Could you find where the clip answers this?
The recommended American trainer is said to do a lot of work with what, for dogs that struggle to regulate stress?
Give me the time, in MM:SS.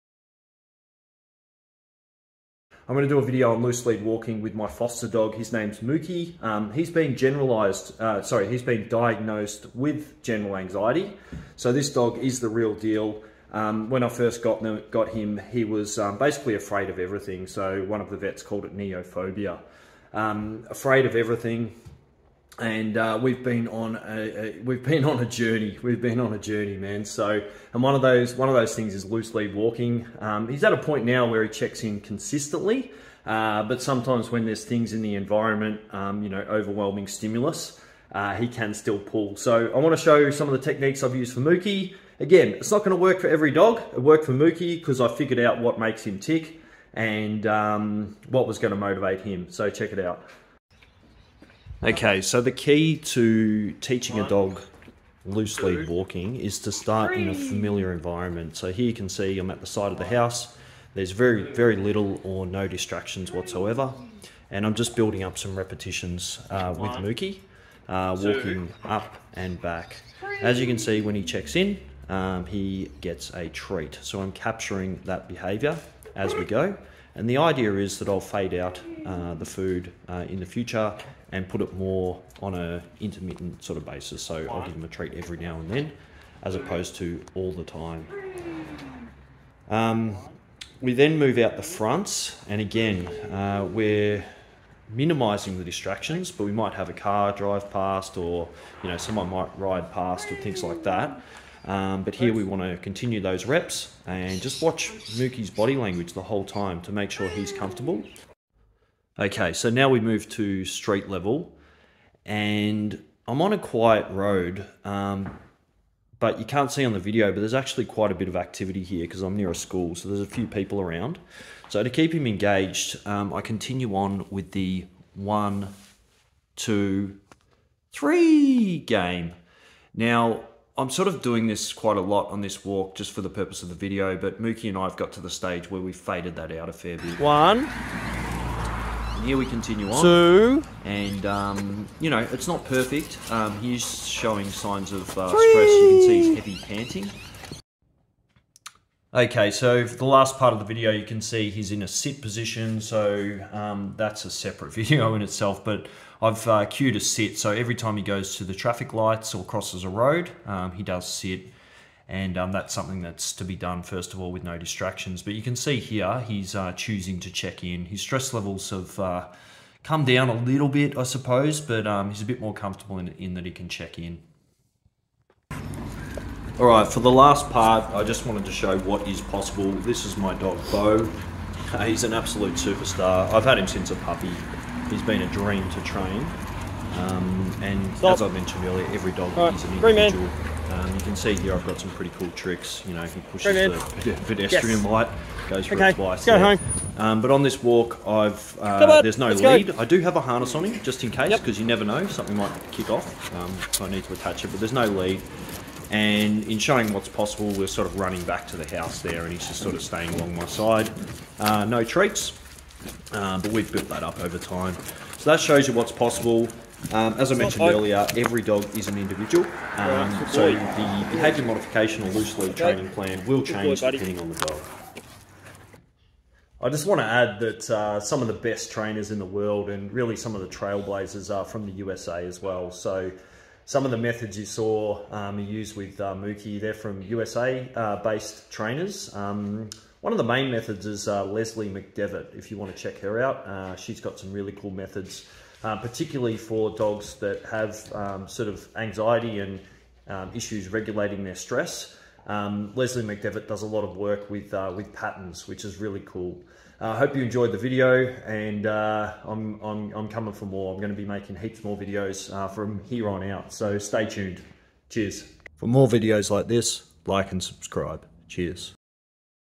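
04:14.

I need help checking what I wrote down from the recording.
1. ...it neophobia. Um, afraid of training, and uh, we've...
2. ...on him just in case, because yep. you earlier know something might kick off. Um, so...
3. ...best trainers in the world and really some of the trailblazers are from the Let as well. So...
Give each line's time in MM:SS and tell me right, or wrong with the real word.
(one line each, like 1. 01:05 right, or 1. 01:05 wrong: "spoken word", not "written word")
1. 00:18 wrong: "everything", not "training"
2. 03:20 wrong: "never", not "earlier"
3. 03:48 wrong: "USA", not "Let".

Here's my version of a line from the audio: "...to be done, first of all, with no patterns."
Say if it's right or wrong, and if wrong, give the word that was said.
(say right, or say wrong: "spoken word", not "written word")
wrong: "distractions", not "patterns".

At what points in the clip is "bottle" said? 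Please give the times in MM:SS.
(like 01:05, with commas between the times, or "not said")
not said.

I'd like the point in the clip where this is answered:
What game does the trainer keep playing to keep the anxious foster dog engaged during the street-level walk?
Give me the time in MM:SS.
02:05.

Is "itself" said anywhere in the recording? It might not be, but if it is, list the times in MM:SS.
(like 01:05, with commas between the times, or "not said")
02:35.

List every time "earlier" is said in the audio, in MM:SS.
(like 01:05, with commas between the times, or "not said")
03:08, 03:37.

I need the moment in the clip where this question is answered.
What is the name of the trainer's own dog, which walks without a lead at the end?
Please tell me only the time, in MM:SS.
03:00.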